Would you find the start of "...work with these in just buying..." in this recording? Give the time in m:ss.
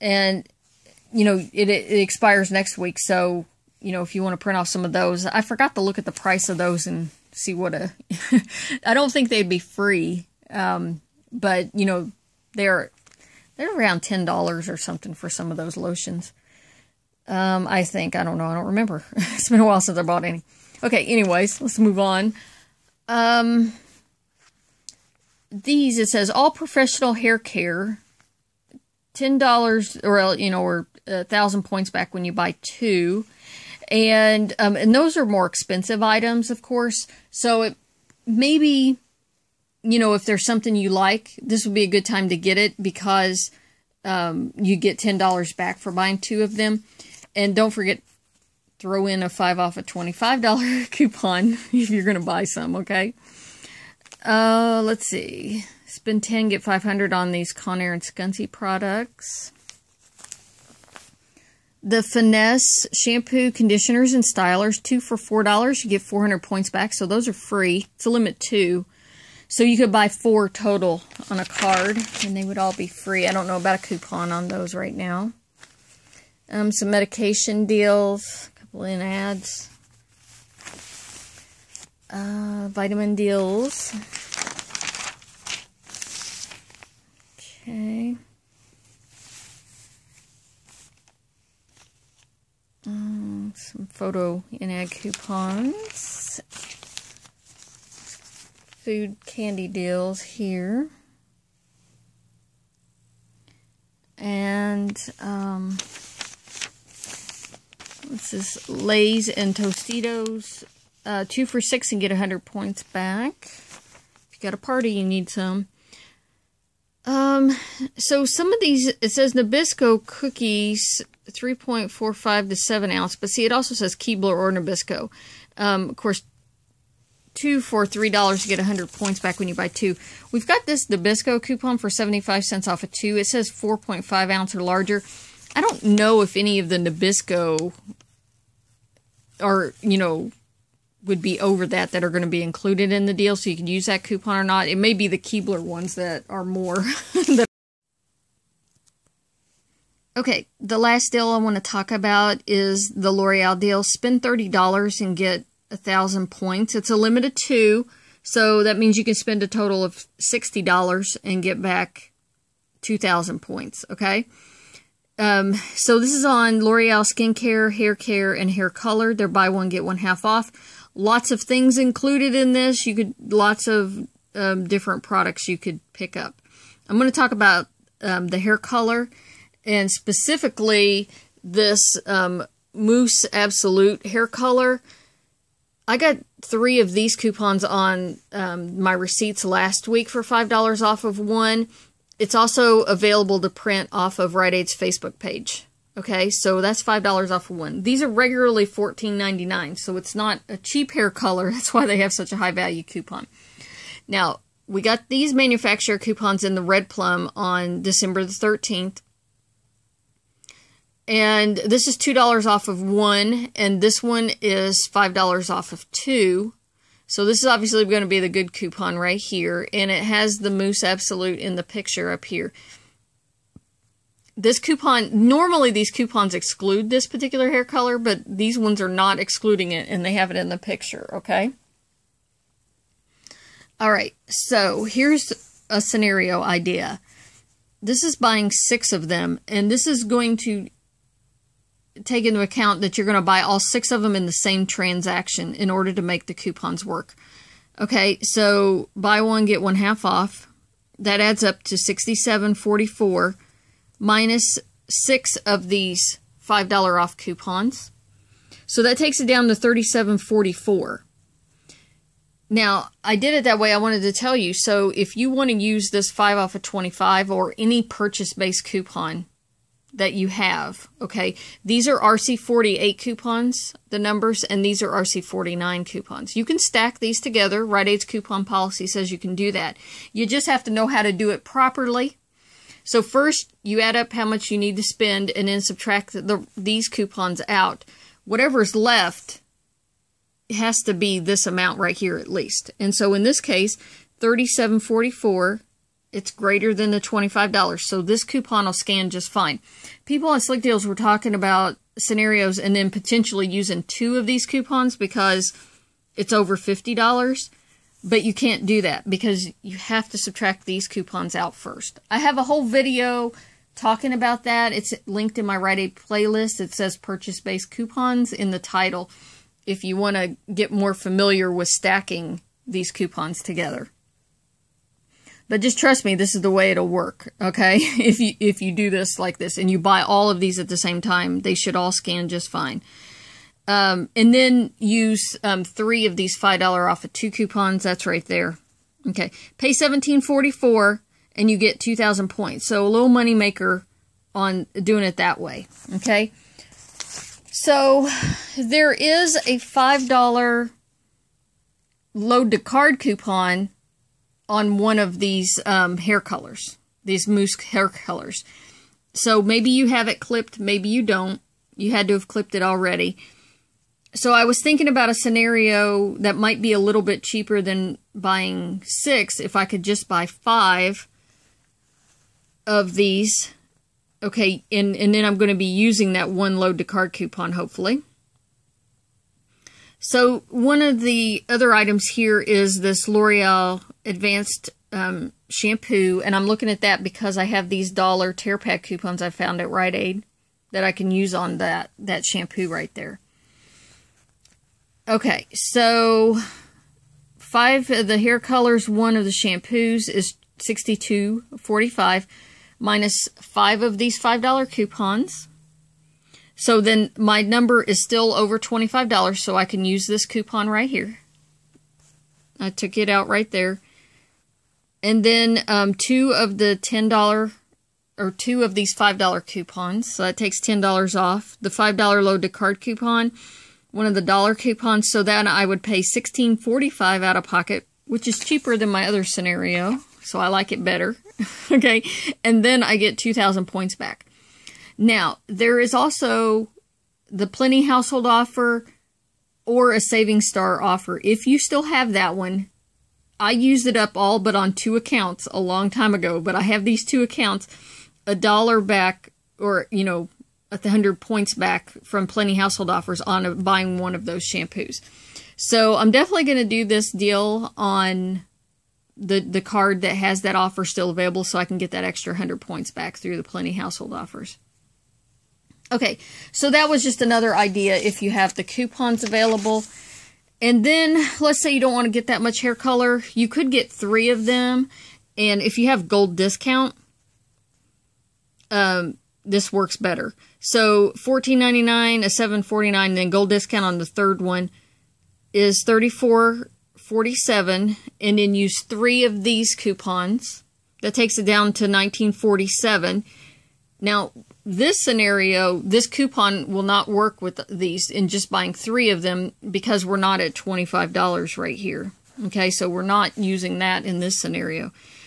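8:17.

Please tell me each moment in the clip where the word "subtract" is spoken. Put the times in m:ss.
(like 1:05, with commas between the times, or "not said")
4:45, 5:10.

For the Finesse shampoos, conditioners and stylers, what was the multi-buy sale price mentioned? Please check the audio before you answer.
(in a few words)
2 for $4.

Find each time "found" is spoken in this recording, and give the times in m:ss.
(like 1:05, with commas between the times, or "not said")
6:29.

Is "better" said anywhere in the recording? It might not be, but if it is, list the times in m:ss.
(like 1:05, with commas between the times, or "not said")
7:10, 7:59.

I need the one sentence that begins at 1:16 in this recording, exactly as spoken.
Um, some medication deals, a couple in ads, uh, vitamin deals.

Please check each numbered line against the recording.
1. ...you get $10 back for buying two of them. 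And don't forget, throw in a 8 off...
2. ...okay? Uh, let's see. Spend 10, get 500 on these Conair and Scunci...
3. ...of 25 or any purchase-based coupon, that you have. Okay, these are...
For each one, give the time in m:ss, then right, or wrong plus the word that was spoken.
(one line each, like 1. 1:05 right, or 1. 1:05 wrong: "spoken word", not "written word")
1. 0:44 wrong: "5", not "8"
2. 0:52 right
3. 4:26 right.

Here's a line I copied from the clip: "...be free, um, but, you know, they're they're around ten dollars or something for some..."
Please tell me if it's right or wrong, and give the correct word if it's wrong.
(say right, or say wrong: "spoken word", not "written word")
right.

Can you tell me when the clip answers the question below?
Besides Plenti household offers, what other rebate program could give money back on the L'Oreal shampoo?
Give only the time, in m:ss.
7:19.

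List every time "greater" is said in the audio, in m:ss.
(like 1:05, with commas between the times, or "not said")
4:56.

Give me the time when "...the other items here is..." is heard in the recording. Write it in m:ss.
6:21.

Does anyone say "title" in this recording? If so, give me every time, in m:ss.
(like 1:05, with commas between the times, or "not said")
5:18.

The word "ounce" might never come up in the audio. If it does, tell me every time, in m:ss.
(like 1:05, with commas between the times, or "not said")
2:02, 2:14.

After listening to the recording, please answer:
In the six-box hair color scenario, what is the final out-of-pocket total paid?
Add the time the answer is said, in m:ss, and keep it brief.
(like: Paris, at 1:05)
$17.44, at 5:39.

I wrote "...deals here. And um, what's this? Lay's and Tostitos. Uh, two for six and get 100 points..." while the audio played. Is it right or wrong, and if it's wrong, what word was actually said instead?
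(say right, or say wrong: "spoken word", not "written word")
right.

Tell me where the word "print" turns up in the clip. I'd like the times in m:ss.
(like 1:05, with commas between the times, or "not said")
0:04, 3:13.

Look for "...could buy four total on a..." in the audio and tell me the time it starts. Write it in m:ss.
1:09.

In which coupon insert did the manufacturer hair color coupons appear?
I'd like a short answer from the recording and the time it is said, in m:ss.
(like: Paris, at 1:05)
Red Plum, at 3:26.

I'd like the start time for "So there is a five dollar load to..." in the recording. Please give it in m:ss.
5:47.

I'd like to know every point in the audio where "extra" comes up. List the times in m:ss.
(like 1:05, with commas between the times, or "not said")
7:42.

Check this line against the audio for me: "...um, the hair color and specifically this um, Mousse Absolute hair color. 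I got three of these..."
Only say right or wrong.
right.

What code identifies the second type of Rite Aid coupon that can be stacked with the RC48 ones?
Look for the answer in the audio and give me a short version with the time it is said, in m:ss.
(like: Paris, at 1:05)
RC49, at 4:34.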